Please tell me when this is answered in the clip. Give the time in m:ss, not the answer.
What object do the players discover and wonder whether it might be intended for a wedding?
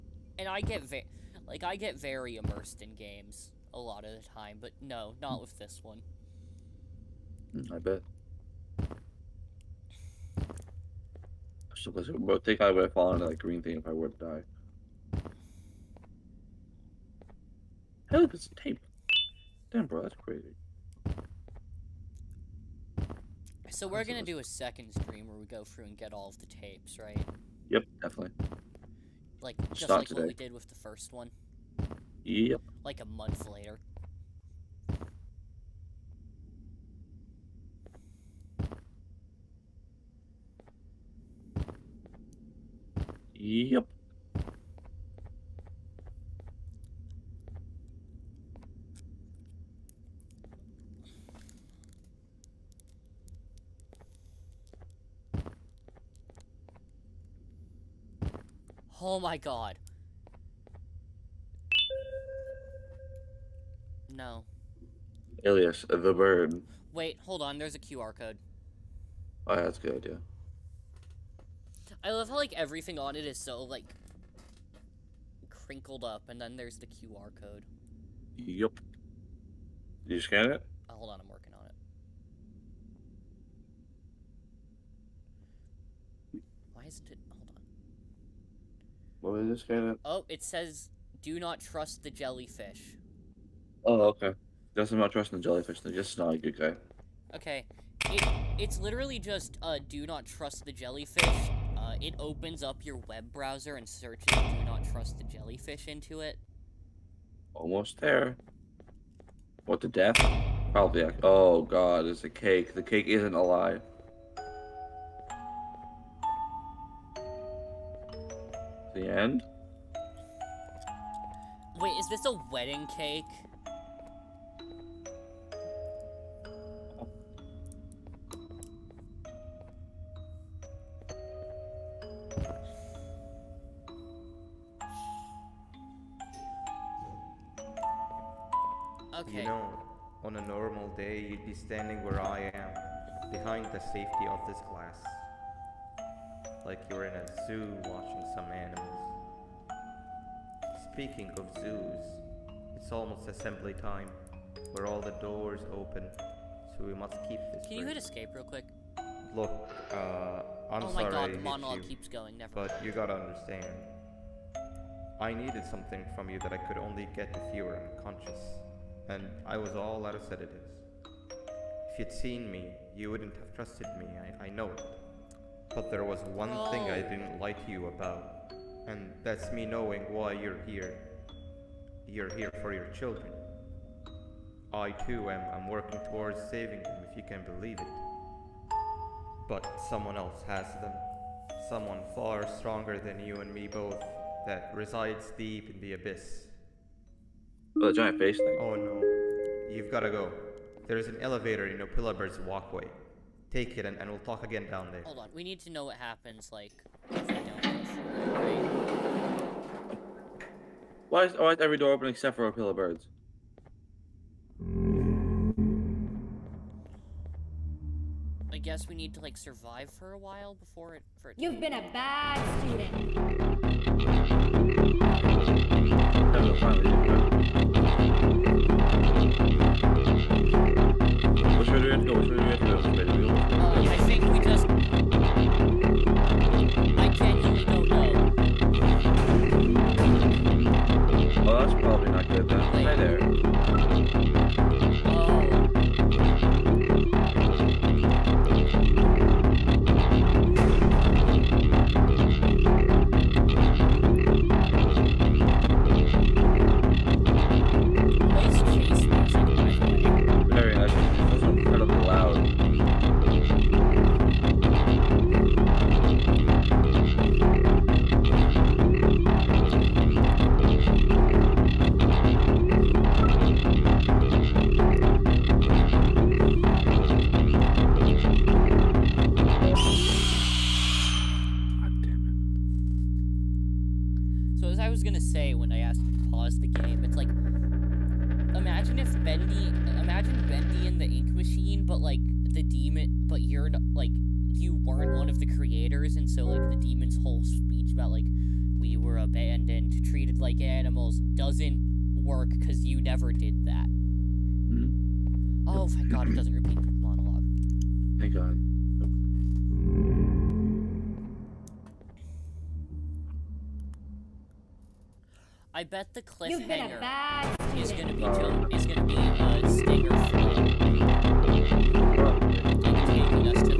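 1:52.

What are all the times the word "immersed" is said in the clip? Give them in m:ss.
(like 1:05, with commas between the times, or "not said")
0:02.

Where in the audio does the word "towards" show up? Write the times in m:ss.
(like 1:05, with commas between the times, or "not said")
3:06.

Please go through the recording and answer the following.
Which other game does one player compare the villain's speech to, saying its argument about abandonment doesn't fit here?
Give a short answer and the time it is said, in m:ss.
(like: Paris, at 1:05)
Bendy and the Ink Machine, at 4:50.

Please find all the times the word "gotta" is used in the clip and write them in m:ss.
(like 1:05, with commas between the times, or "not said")
2:42, 3:19.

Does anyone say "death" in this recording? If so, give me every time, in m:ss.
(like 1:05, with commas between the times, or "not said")
1:49.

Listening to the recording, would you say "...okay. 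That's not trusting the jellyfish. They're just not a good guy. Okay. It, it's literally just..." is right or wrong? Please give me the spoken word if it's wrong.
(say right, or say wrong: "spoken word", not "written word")
right.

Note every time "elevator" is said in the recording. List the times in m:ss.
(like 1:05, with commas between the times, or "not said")
3:21.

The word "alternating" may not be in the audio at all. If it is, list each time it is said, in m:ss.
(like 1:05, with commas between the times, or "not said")
not said.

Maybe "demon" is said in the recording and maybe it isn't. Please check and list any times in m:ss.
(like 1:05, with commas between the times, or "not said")
4:52, 4:56.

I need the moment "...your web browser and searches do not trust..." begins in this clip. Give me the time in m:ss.
1:42.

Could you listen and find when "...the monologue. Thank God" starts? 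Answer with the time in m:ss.
5:06.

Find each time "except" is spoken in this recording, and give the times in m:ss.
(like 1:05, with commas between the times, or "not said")
3:32.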